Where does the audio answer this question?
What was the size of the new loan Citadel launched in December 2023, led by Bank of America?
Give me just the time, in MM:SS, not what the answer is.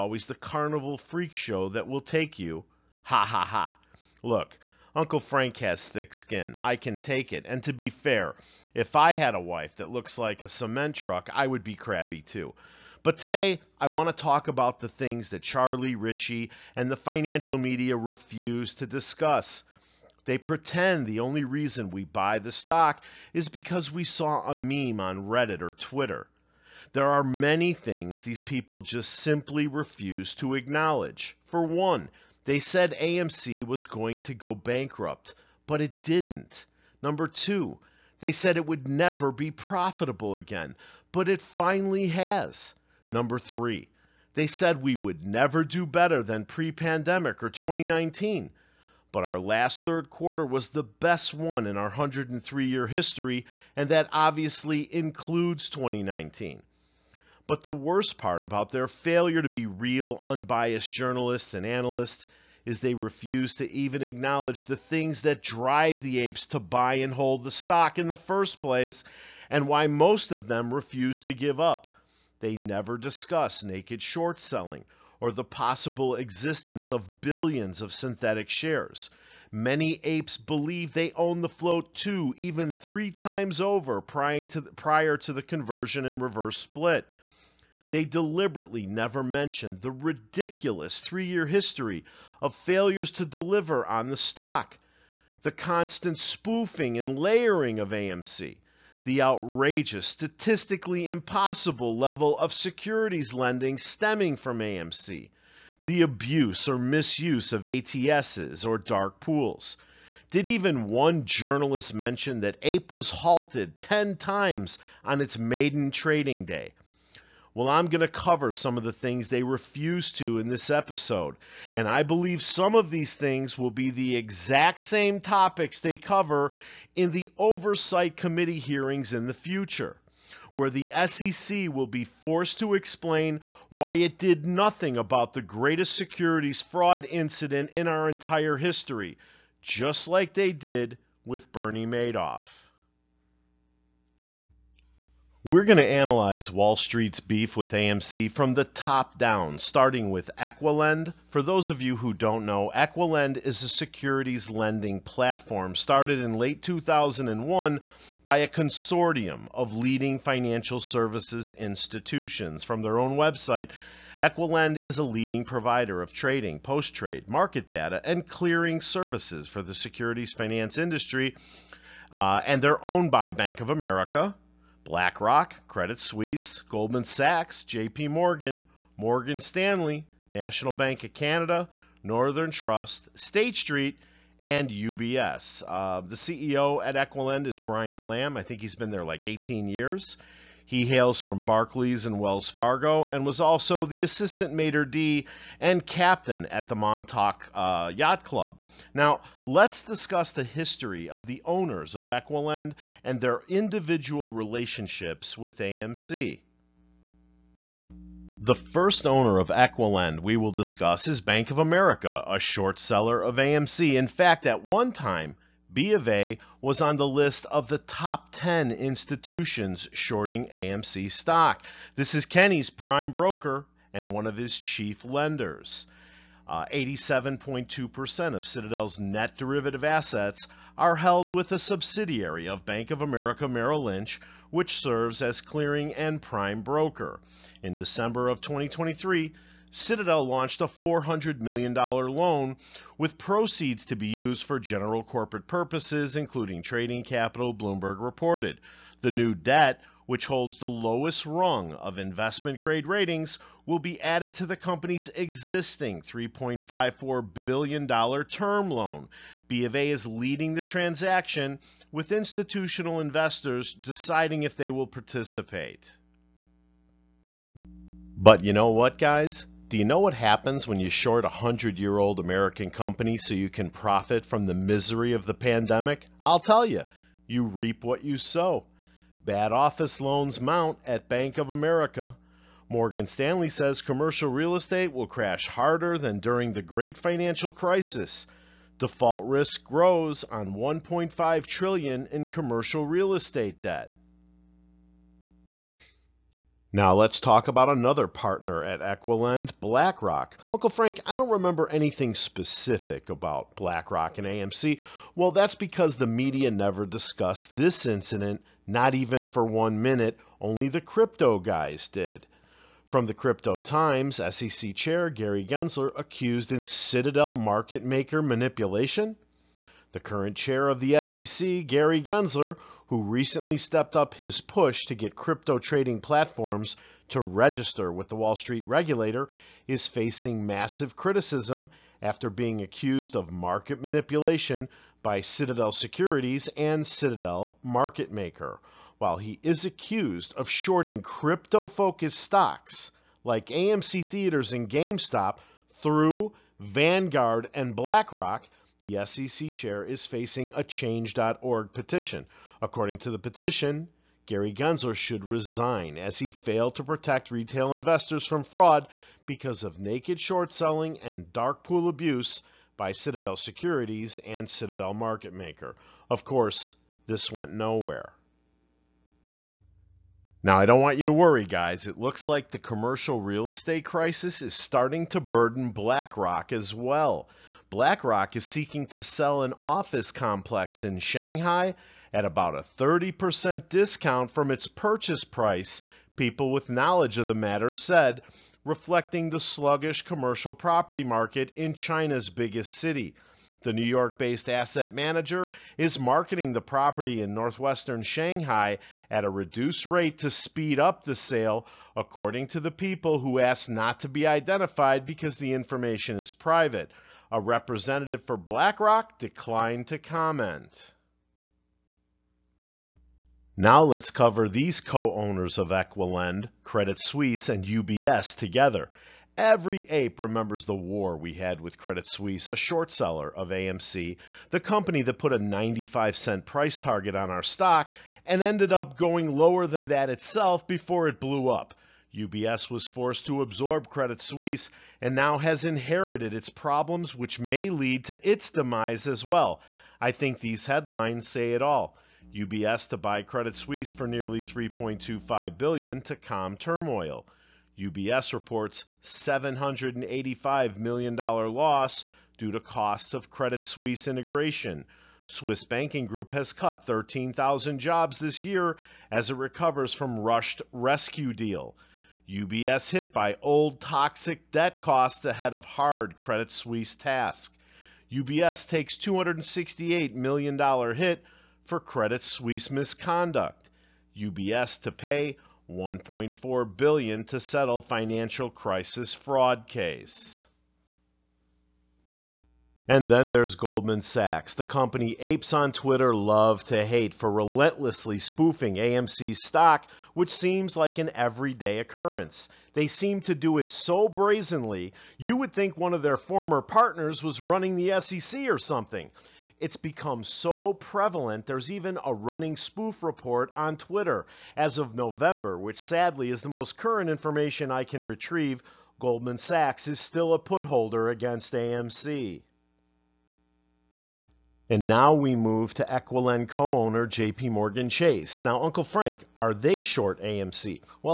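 04:00.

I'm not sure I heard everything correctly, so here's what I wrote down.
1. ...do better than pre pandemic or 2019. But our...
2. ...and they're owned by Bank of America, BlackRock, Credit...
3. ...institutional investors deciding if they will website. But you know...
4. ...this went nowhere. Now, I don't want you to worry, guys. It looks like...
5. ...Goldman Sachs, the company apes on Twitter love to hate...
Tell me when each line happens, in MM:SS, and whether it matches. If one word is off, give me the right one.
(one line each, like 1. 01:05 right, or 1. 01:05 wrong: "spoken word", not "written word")
1. 00:45 right
2. 02:52 right
3. 04:22 wrong: "participate", not "website"
4. 06:07 right
5. 08:03 right.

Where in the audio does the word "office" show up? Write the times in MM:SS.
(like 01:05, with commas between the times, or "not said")
04:39, 06:19.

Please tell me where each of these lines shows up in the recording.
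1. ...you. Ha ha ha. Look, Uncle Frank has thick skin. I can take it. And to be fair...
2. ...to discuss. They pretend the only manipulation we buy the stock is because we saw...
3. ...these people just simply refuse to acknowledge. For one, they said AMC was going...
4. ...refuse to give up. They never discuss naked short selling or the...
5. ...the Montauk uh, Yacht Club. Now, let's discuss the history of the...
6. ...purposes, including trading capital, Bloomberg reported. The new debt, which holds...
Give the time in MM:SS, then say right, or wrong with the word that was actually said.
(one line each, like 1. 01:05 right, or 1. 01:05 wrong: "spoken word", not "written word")
1. 00:02 right
2. 00:18 wrong: "reason", not "manipulation"
3. 00:28 right
4. 01:10 right
5. 03:16 right
6. 04:05 right.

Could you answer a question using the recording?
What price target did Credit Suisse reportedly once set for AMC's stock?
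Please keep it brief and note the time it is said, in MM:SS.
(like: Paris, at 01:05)
95 cents, at 07:05.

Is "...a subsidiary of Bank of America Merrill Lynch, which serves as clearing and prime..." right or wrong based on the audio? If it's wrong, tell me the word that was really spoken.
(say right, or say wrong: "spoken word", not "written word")
right.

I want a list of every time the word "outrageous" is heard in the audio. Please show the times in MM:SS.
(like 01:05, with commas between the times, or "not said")
01:39.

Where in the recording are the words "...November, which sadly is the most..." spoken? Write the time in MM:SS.
08:24.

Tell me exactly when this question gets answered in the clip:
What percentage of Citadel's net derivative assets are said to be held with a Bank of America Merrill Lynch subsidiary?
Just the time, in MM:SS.
03:46.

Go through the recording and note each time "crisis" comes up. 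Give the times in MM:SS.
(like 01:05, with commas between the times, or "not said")
04:47, 06:13, 07:58.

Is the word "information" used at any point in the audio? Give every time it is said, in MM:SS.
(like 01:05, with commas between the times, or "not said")
06:45, 08:27.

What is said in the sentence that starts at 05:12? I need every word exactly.
From the Crypto Times, SEC Chair Gary Gensler accused in Citadel market maker manipulation.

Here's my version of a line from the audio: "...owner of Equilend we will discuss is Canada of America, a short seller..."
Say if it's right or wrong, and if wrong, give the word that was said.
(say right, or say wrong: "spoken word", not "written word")
wrong: "Bank", not "Canada".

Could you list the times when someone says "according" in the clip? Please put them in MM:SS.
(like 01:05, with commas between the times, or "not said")
05:52, 06:41.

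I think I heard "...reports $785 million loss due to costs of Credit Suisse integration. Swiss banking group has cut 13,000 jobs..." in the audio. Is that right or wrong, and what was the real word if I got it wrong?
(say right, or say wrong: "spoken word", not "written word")
right.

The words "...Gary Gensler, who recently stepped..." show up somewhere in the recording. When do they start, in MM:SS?
05:21.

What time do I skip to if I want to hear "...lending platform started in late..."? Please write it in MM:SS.
02:34.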